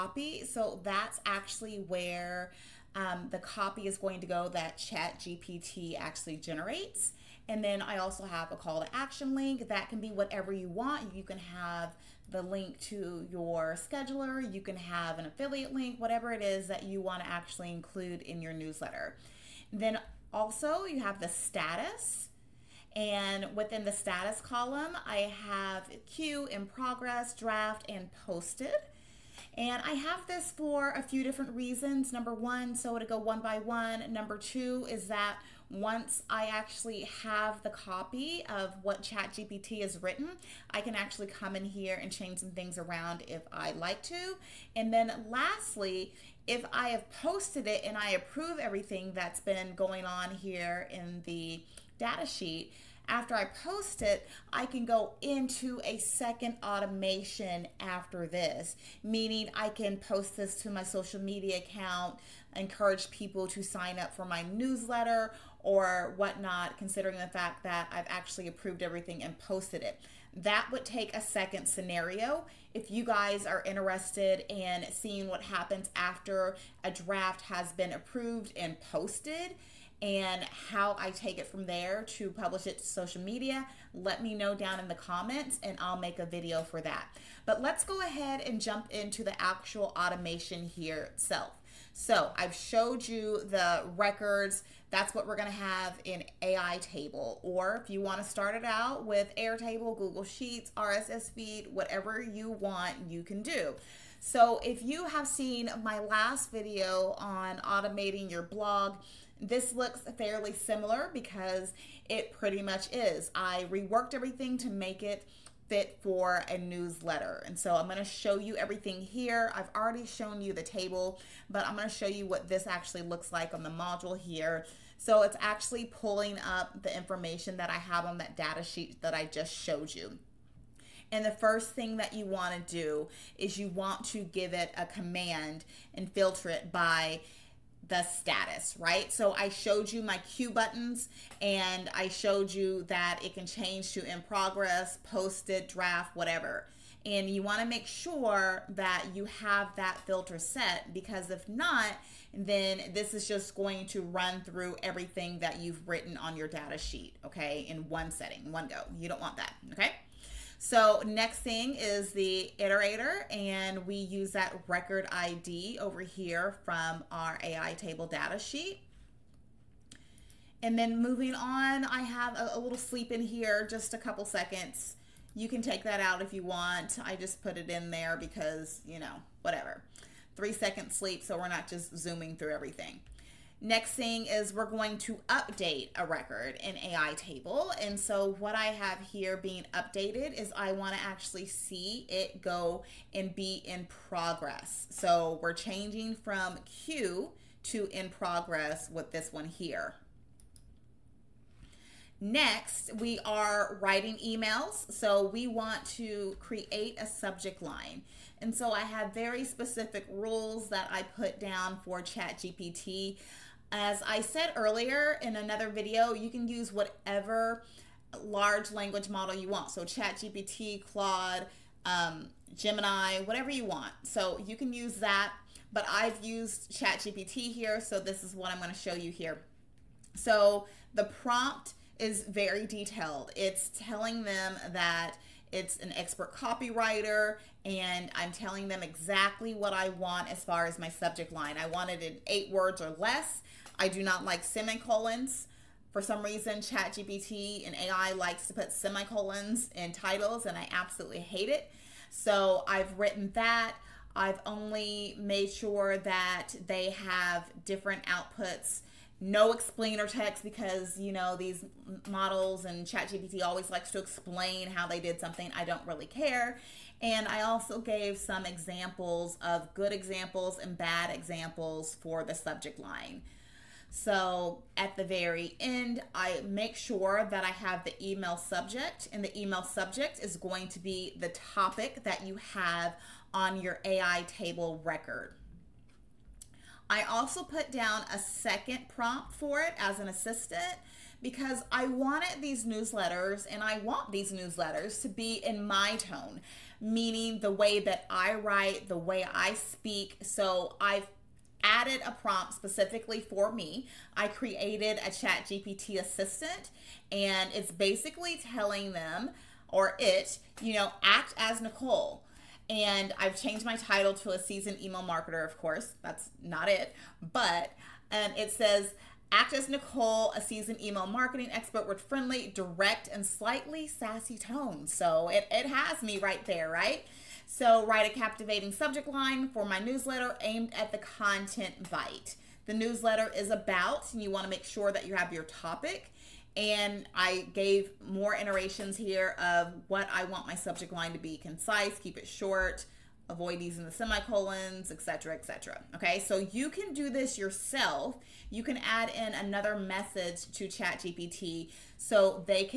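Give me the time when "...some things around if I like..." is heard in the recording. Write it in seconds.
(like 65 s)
42 s.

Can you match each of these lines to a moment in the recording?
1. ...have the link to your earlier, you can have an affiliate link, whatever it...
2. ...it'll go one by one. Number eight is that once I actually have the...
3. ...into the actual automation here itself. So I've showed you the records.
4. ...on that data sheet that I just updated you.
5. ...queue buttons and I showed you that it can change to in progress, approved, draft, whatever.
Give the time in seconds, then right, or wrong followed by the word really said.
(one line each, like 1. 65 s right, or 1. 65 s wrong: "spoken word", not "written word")
1. 11 s wrong: "scheduler", not "earlier"
2. 32 s wrong: "two", not "eight"
3. 88 s right
4. 128 s wrong: "showed", not "updated"
5. 140 s wrong: "posted", not "approved".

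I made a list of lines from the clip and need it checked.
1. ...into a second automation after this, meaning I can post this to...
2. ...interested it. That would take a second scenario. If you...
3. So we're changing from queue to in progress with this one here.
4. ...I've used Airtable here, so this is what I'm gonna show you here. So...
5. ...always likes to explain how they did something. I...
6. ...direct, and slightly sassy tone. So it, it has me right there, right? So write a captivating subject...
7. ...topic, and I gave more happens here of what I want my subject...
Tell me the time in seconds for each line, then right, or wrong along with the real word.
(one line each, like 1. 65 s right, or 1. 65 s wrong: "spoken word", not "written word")
1. 55 s right
2. 69 s wrong: "posted", not "interested"
3. 194 s right
4. 225 s wrong: "ChatGPT", not "Airtable"
5. 263 s right
6. 322 s right
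7. 335 s wrong: "iterations", not "happens".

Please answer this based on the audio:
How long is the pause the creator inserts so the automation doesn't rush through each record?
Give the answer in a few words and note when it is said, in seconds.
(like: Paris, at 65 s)
3 seconds, at 180 s.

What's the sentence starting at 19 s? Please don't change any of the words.
Then also, you have the status.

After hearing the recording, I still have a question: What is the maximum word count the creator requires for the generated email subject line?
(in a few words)
8 words.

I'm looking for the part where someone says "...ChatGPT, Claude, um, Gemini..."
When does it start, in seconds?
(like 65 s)
219 s.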